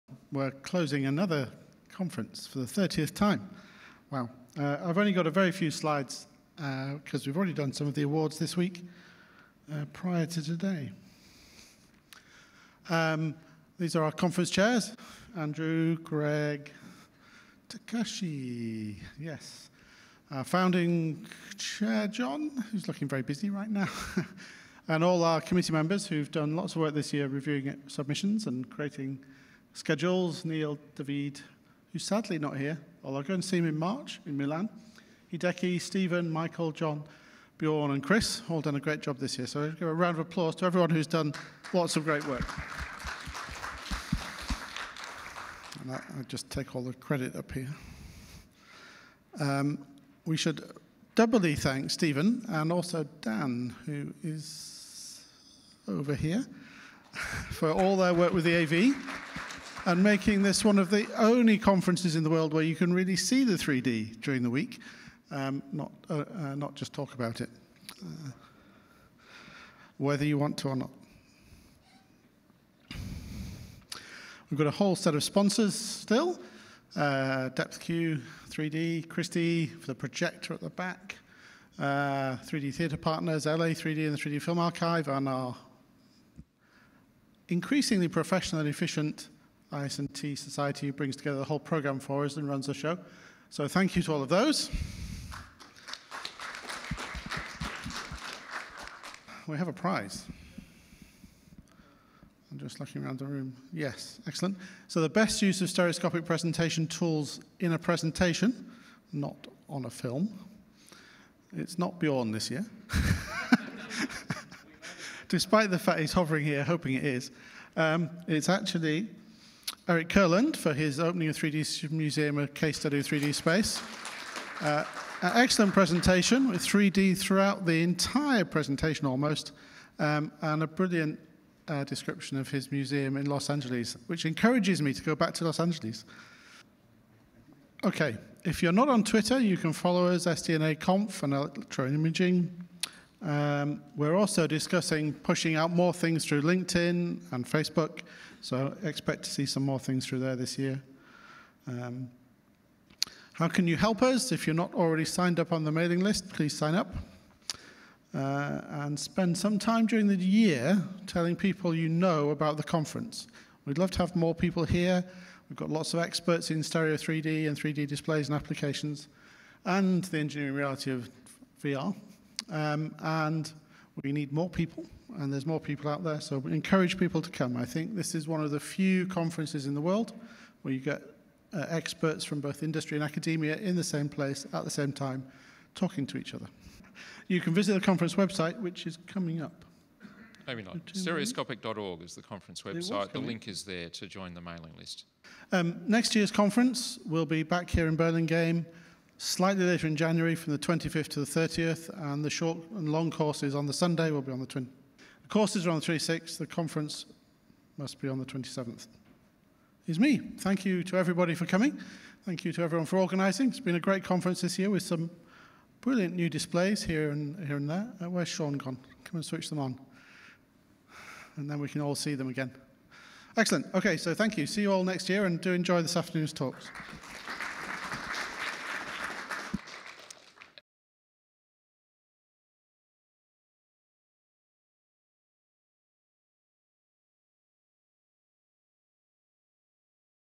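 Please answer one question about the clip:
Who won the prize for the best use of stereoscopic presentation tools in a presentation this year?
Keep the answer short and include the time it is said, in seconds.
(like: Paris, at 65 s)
Eric Kurland, at 119 s.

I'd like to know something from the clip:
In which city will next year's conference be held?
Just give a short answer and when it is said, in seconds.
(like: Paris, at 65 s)
Burlingame, at 197 s.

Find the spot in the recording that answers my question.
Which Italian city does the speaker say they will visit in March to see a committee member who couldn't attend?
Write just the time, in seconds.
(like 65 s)
34 s.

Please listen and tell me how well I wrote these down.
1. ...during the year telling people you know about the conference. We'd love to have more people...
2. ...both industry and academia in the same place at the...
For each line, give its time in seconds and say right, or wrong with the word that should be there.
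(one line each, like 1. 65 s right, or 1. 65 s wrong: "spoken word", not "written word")
1. 159 s right
2. 182 s right.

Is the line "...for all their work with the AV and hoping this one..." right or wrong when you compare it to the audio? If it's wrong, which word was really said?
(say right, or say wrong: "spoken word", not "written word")
wrong: "making", not "hoping".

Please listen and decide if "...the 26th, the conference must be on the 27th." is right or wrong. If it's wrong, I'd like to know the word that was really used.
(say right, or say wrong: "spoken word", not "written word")
right.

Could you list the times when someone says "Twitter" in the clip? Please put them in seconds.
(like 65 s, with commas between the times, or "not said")
139 s.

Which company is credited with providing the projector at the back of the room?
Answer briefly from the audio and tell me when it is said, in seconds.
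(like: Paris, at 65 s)
Christie, at 79 s.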